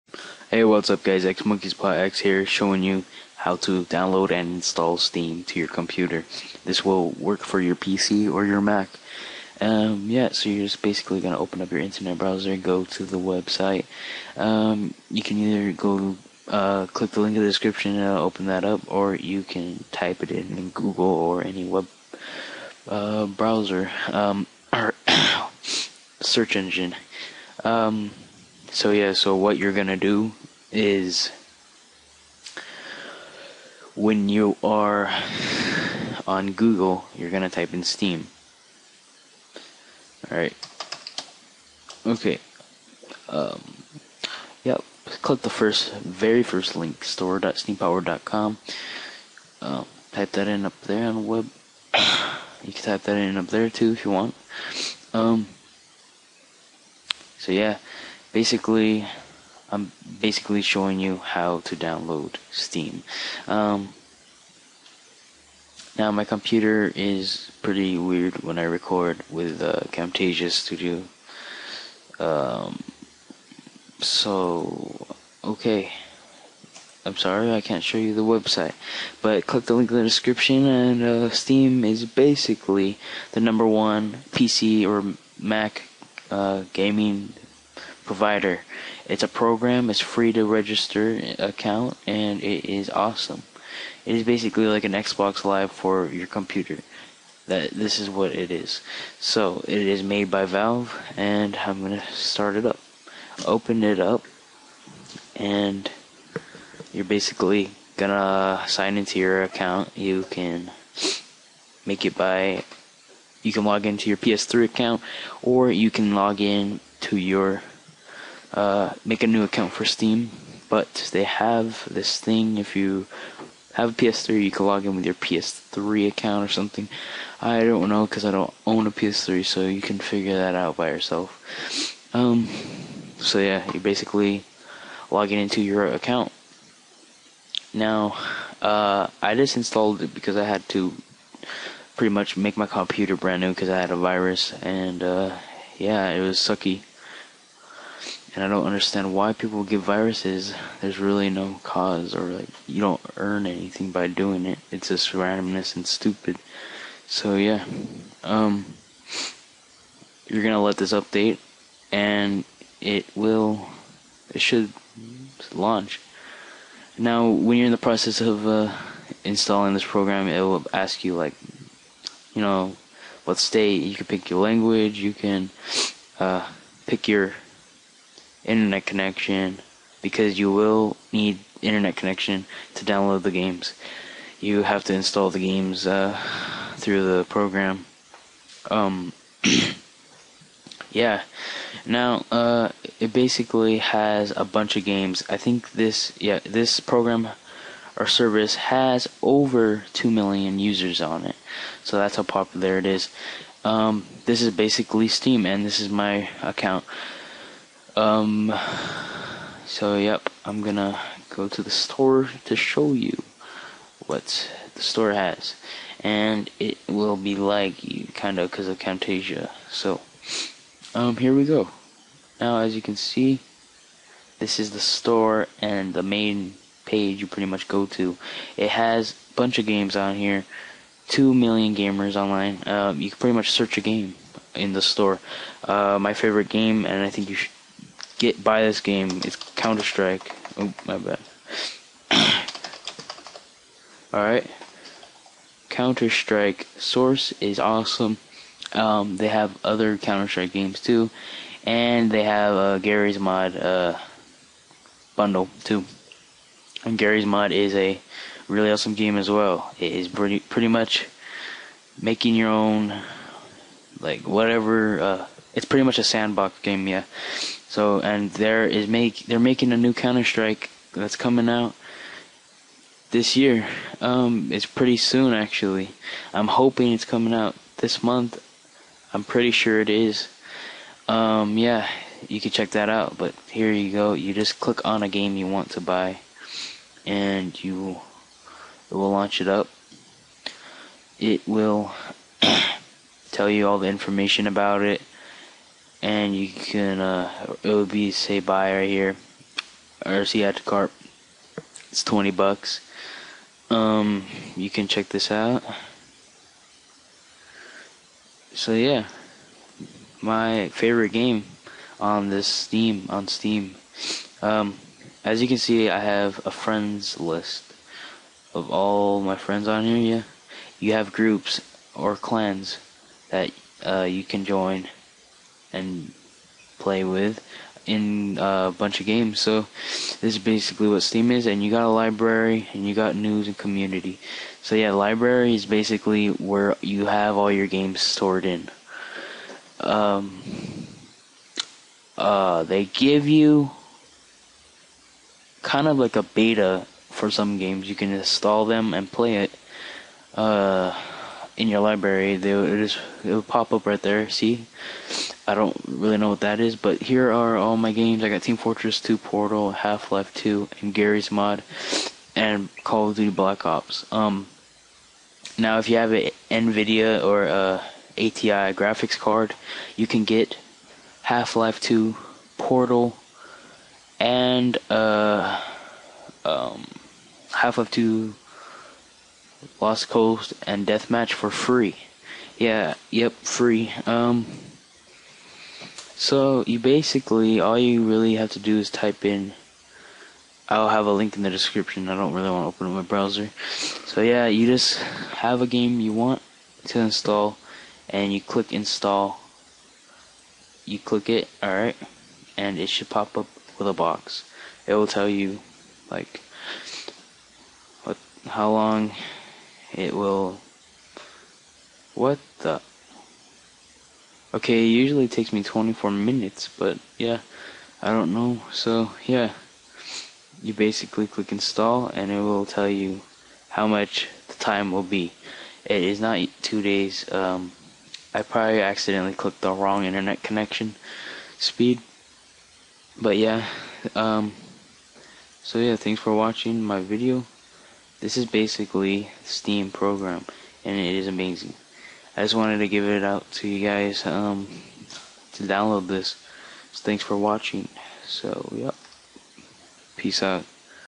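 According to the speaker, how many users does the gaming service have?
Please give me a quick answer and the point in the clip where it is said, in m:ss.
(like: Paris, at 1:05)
2 million, at 3:19.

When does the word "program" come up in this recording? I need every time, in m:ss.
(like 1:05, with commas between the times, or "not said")
1:29, 2:49, 3:07, 3:16, 7:19.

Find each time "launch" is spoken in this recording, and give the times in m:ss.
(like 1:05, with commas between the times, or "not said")
2:45, 4:49.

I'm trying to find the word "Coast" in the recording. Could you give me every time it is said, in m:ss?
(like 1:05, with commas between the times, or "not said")
6:20.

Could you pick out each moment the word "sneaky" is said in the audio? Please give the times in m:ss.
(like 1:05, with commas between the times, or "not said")
not said.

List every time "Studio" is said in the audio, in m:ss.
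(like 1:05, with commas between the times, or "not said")
1:10.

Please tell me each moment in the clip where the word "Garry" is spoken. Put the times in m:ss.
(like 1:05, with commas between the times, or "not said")
4:12, 4:16, 6:00.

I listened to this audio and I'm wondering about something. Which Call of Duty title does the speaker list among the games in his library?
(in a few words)
Black Ops.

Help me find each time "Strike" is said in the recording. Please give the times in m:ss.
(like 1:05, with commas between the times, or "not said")
3:59, 4:06, 4:10, 4:30.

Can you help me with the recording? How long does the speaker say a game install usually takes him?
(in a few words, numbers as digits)
24 minutes.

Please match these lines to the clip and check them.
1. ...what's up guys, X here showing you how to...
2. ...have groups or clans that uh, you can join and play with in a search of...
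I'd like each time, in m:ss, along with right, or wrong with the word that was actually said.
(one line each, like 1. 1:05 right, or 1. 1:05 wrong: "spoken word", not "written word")
1. 0:00 right
2. 5:20 wrong: "bunch", not "search".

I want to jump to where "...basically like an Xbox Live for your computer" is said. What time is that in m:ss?
1:34.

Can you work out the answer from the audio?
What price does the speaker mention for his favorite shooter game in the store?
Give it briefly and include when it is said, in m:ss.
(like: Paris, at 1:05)
20 bucks, at 5:02.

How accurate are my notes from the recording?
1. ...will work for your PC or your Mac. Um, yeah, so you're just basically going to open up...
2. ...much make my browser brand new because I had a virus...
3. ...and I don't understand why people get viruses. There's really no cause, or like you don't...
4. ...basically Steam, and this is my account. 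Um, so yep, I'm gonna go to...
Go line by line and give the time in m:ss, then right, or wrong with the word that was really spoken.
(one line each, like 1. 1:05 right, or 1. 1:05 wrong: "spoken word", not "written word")
1. 0:06 right
2. 2:22 wrong: "computer", not "browser"
3. 2:28 right
4. 3:24 right.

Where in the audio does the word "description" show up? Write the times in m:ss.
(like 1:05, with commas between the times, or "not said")
0:17, 1:20, 6:31.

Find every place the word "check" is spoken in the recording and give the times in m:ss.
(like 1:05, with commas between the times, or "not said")
4:42, 5:04.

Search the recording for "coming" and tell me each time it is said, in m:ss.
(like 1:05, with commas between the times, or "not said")
4:31, 4:37.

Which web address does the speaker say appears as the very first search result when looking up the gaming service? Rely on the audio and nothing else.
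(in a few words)
store.steampower.com.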